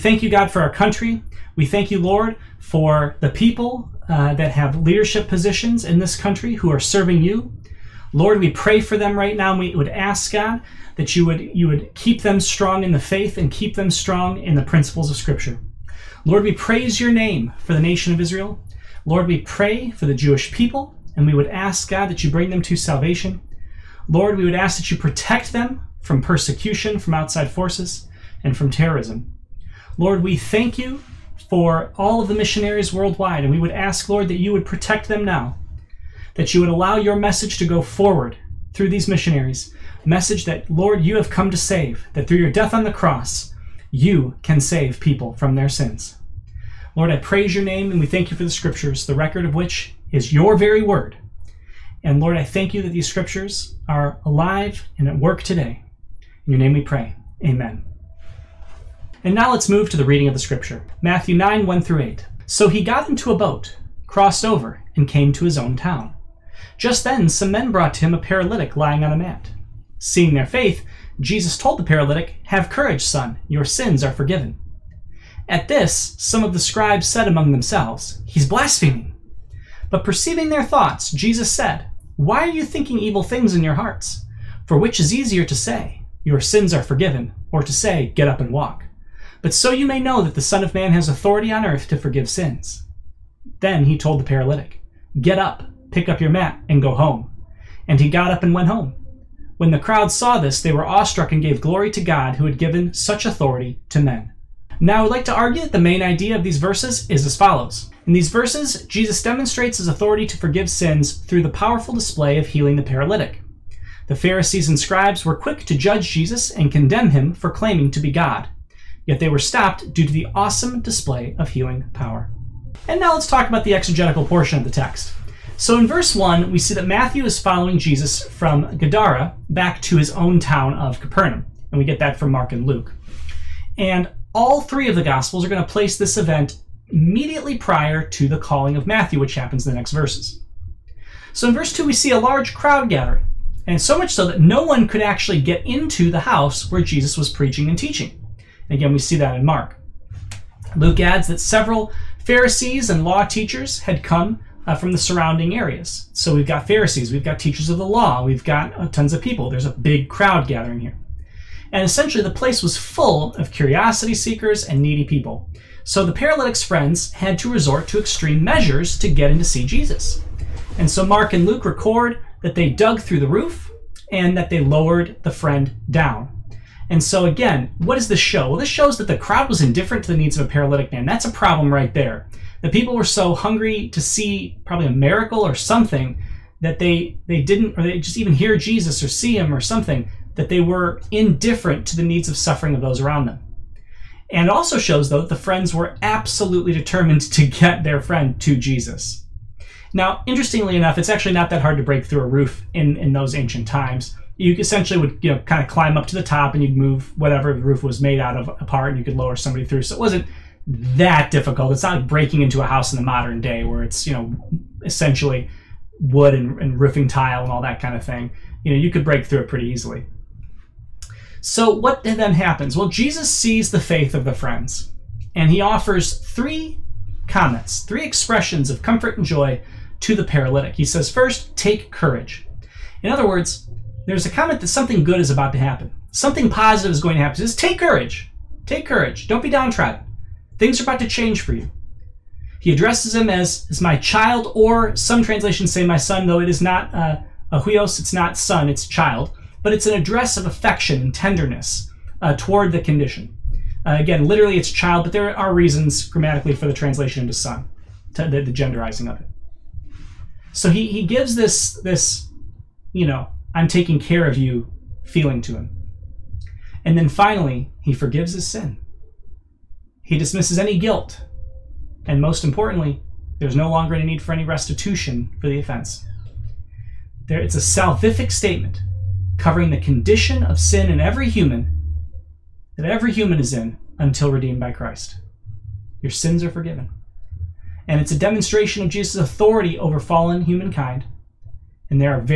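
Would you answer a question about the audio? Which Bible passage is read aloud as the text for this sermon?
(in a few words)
Matthew 9:1-8.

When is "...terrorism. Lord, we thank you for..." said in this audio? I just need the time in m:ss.
0:28.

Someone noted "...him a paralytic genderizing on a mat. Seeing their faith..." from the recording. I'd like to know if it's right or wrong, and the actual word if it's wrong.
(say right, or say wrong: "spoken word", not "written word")
wrong: "lying", not "genderizing".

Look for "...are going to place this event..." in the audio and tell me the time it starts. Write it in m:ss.
2:15.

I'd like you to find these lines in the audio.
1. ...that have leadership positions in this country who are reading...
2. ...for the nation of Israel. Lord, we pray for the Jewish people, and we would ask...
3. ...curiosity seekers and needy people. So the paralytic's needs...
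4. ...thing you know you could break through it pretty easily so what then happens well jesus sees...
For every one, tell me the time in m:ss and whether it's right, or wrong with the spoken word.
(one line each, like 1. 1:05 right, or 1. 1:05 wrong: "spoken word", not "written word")
1. 0:04 wrong: "serving", not "reading"
2. 0:17 right
3. 2:43 wrong: "friends", not "needs"
4. 3:38 right.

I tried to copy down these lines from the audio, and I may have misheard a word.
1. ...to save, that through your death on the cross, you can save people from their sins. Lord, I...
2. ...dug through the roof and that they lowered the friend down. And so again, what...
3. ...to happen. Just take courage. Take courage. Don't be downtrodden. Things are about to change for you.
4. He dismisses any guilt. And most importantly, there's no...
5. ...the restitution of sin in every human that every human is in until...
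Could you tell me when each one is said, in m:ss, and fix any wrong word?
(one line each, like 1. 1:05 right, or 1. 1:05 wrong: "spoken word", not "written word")
1. 0:41 right
2. 2:52 right
3. 3:57 right
4. 4:30 right
5. 4:39 wrong: "condition", not "restitution".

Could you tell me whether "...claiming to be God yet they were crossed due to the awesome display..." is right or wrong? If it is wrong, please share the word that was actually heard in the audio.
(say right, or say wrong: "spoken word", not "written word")
wrong: "stopped", not "crossed".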